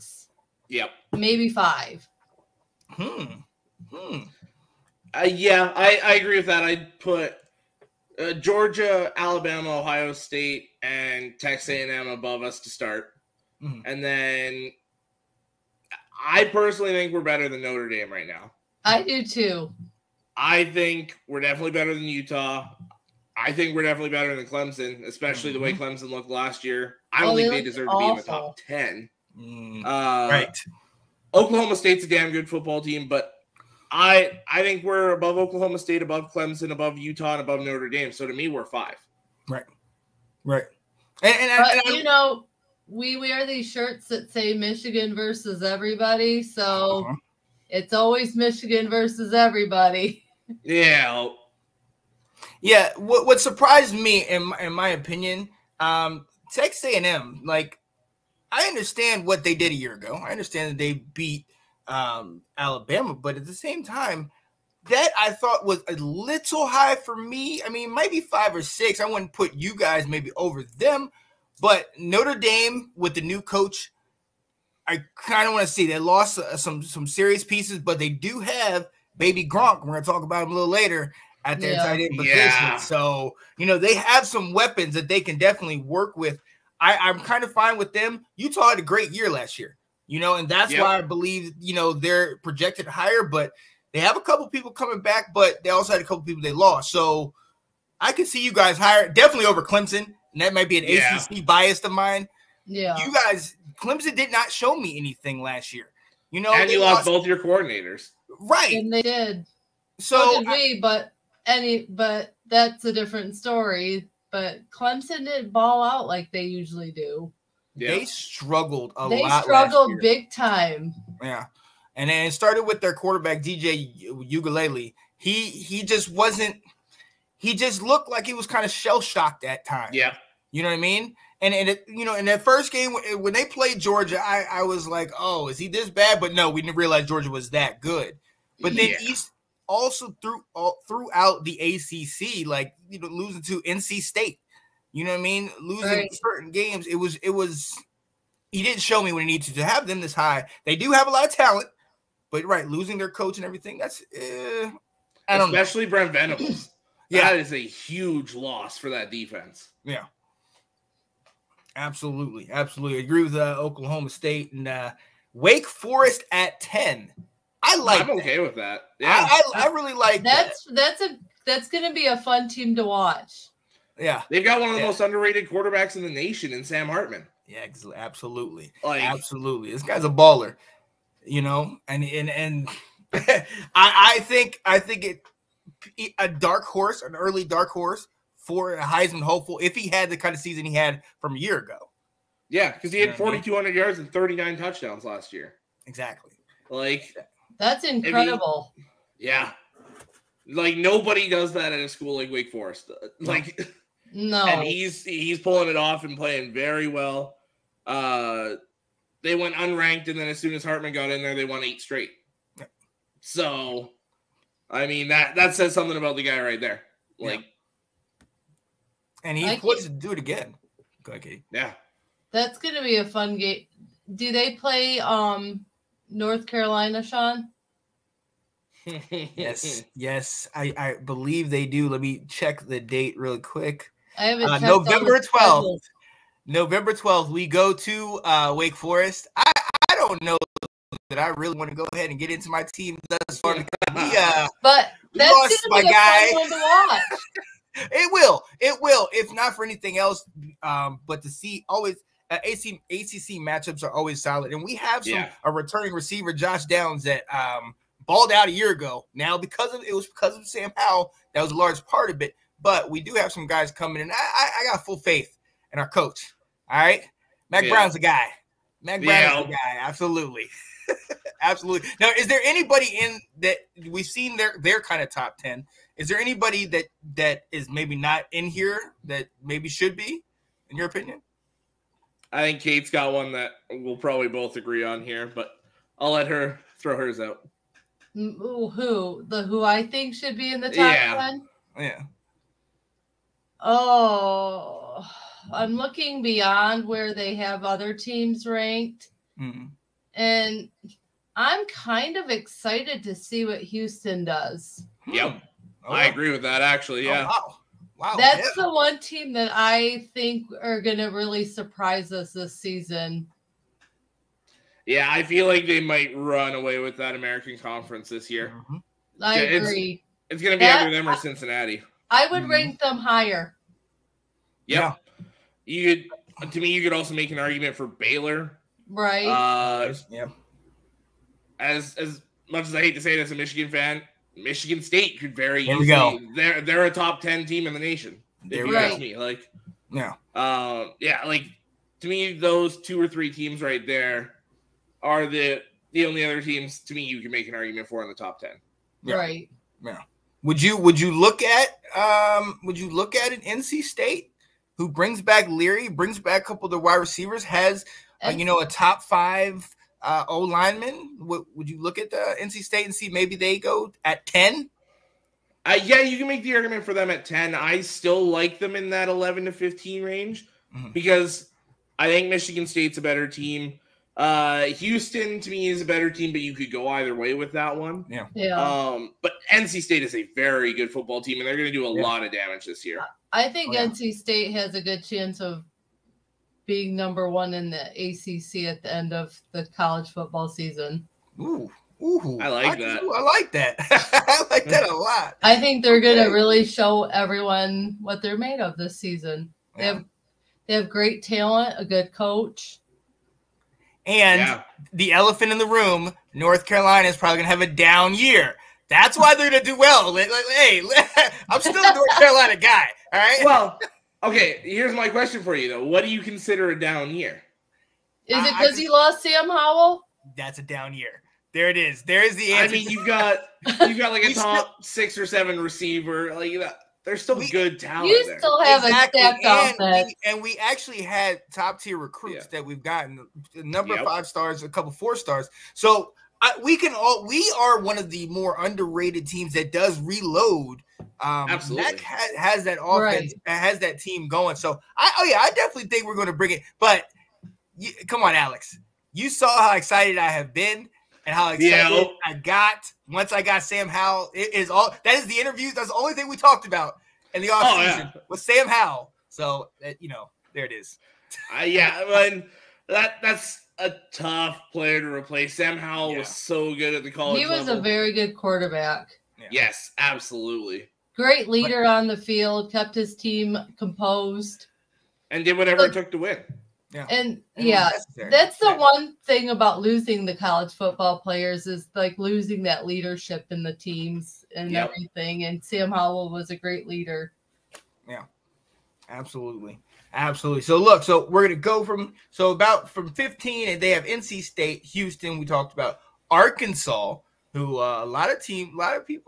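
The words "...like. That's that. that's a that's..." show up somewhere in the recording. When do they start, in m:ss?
2:49.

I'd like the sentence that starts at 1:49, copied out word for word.
So, so did I, we, but any but that's a different story but Clemson didn't ball out like they usually do.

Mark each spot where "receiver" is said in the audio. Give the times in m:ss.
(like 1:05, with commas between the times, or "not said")
4:15, 5:56, 7:05.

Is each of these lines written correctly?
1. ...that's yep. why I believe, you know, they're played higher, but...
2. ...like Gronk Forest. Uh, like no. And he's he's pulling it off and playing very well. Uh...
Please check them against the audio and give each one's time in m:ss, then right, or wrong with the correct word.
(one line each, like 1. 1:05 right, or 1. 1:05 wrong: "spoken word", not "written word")
1. 1:30 wrong: "projected", not "played"
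2. 3:22 wrong: "Wake", not "Gronk".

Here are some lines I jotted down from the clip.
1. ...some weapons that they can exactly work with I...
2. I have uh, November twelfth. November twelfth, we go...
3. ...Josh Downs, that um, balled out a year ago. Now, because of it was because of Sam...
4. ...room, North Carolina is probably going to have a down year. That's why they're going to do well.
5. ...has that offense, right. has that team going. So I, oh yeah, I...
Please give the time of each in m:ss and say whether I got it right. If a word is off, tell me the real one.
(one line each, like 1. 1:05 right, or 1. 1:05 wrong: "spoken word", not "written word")
1. 1:24 wrong: "definitely", not "exactly"
2. 3:54 right
3. 4:16 right
4. 6:45 right
5. 7:22 right.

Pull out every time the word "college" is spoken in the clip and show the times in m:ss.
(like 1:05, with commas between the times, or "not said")
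6:29, 7:47, 8:00.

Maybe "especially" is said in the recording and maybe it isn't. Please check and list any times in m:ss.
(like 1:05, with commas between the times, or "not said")
0:25, 2:35.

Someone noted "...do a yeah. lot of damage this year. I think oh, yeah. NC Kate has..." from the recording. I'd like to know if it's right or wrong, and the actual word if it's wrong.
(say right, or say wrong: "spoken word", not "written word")
wrong: "State", not "Kate".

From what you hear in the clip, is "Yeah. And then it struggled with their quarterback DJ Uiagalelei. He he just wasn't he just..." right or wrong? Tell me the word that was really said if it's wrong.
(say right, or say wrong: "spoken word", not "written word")
wrong: "started", not "struggled".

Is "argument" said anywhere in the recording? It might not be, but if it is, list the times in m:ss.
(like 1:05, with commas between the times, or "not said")
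5:27, 5:47, 6:06.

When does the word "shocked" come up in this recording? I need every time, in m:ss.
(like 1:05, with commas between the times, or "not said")
2:09.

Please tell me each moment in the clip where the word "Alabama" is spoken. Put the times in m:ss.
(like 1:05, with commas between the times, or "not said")
0:09, 1:02.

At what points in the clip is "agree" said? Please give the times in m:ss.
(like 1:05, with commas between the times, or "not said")
0:06, 2:43, 4:44, 5:06, 5:19.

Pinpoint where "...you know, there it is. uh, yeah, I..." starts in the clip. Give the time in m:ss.
7:39.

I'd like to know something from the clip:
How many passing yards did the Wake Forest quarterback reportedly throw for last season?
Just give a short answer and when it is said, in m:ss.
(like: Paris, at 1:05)
4,200, at 3:13.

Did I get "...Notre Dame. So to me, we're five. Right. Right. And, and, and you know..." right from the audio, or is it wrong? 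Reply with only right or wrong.
right.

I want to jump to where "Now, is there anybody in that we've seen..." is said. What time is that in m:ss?
4:31.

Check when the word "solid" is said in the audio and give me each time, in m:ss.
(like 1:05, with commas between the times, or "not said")
4:14.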